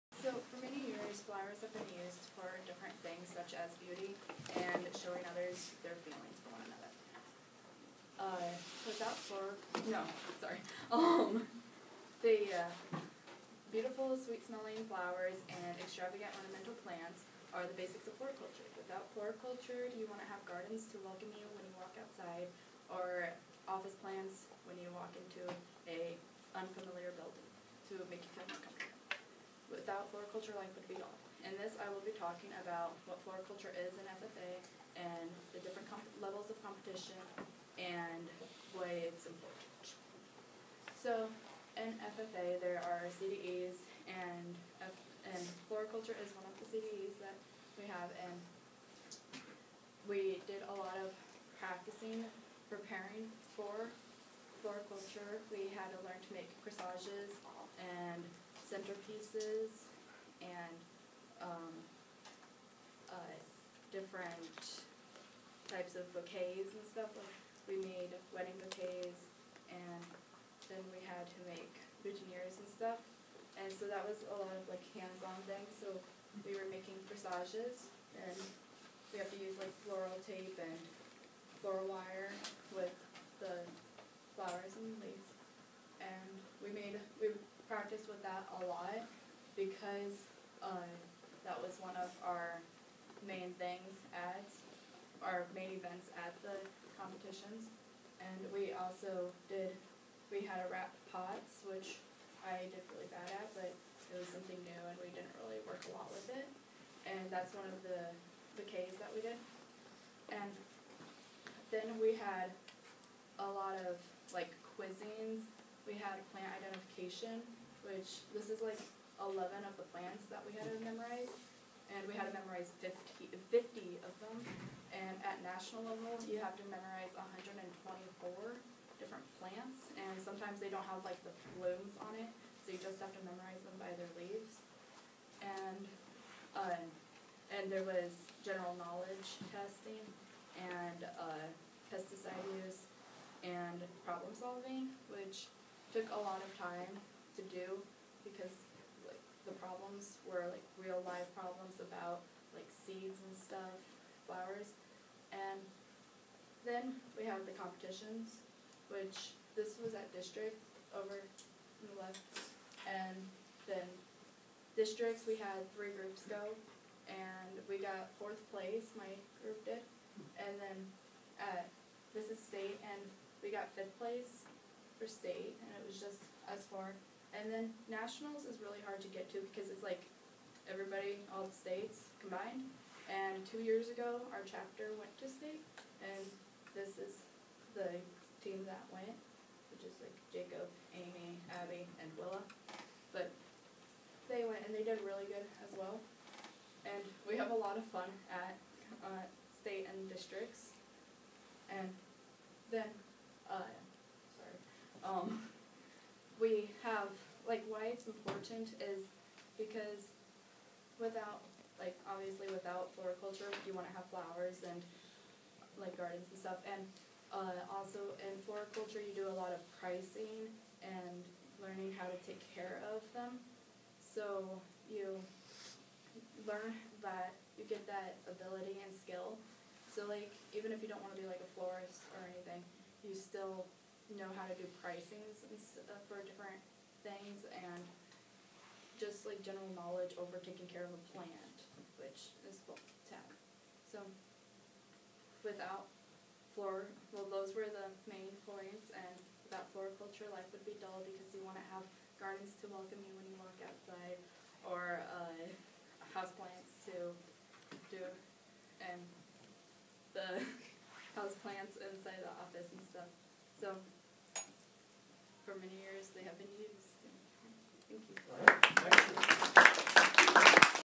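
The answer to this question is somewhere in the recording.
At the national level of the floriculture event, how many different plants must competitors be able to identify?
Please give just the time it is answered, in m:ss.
2:07.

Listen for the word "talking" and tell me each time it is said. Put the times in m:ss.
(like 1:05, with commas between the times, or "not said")
0:32.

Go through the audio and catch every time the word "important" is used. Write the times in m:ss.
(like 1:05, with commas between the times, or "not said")
0:39, 3:28.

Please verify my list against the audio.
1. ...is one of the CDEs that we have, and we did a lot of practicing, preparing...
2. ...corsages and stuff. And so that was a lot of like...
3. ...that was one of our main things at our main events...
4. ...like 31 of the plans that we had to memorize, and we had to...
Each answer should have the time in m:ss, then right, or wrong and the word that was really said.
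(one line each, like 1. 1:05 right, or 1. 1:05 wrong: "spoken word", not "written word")
1. 0:46 right
2. 1:12 wrong: "boutonnieres", not "corsages"
3. 1:31 right
4. 1:58 wrong: "11", not "31".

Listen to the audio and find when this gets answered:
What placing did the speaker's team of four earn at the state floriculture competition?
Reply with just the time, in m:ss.
2:53.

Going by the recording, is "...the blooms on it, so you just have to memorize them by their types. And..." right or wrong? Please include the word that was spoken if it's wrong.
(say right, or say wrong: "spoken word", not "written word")
wrong: "leaves", not "types".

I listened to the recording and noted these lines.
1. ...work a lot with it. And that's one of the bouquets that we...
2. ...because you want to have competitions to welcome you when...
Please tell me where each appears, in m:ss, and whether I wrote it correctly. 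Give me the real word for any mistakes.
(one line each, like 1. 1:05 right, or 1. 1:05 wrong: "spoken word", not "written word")
1. 1:45 right
2. 4:11 wrong: "gardens", not "competitions".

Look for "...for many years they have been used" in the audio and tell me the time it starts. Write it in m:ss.
4:25.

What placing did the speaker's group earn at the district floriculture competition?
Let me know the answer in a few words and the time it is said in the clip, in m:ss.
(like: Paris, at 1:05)
Fourth place, at 2:48.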